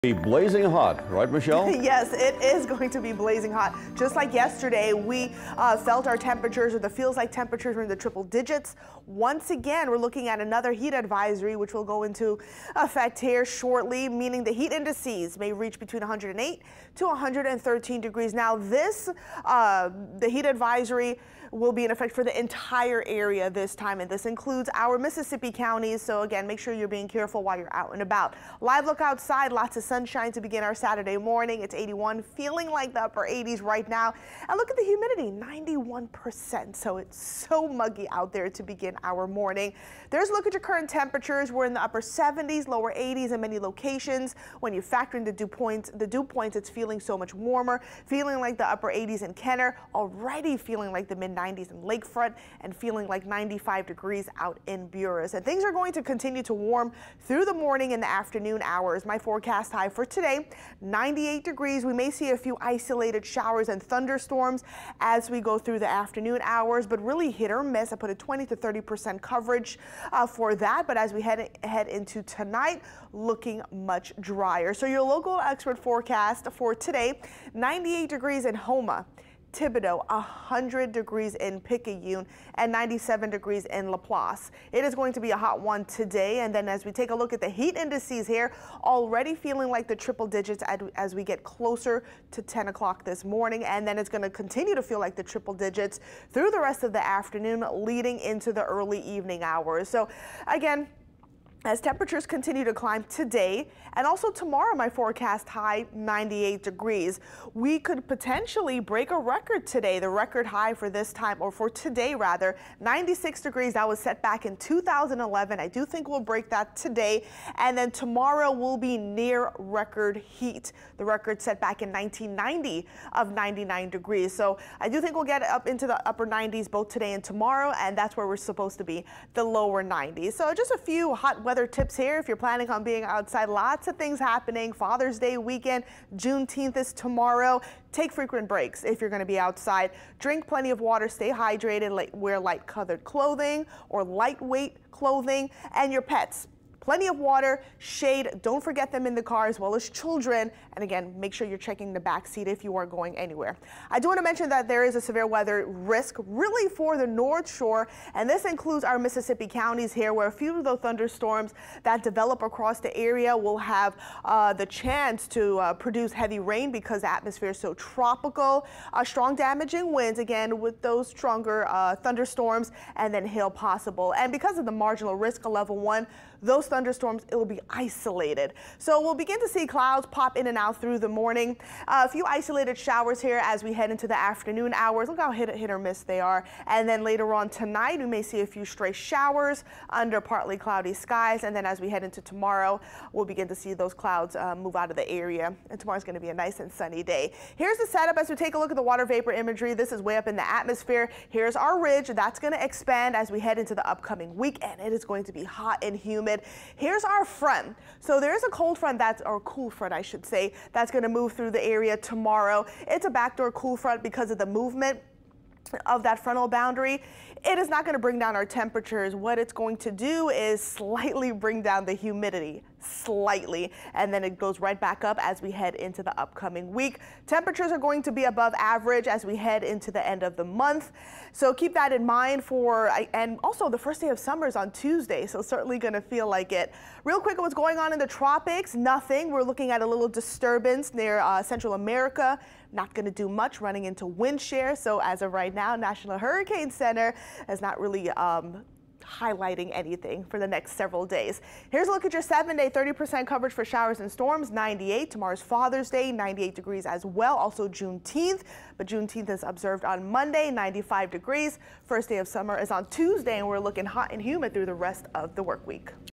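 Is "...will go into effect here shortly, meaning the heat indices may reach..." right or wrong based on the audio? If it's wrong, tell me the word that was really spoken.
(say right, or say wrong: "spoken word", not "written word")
right.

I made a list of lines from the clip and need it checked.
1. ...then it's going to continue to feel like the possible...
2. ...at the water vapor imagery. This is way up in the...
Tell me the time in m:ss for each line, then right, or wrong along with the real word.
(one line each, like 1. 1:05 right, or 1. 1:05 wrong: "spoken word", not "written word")
1. 1:33 wrong: "triple", not "possible"
2. 3:18 right.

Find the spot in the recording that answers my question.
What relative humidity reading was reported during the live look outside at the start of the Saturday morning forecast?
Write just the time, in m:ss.
0:35.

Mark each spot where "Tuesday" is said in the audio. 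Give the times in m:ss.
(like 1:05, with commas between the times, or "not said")
3:54, 4:22.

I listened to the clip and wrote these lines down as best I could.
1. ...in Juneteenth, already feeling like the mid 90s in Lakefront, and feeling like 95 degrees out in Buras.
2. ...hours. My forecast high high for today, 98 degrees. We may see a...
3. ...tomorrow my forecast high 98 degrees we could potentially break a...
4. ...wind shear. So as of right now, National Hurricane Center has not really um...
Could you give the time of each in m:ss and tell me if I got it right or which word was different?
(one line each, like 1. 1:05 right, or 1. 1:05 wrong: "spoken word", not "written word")
1. 0:49 wrong: "Kenner", not "Juneteenth"
2. 0:58 right
3. 1:44 right
4. 4:04 right.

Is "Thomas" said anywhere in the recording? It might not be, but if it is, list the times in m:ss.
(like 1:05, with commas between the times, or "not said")
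not said.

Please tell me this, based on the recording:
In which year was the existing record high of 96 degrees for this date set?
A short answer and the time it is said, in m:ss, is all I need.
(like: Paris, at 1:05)
2011, at 1:54.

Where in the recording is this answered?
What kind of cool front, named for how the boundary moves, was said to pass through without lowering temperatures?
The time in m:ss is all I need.
3:33.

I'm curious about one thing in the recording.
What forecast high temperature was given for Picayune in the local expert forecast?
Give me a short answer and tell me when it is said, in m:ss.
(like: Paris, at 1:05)
100 degrees, at 1:20.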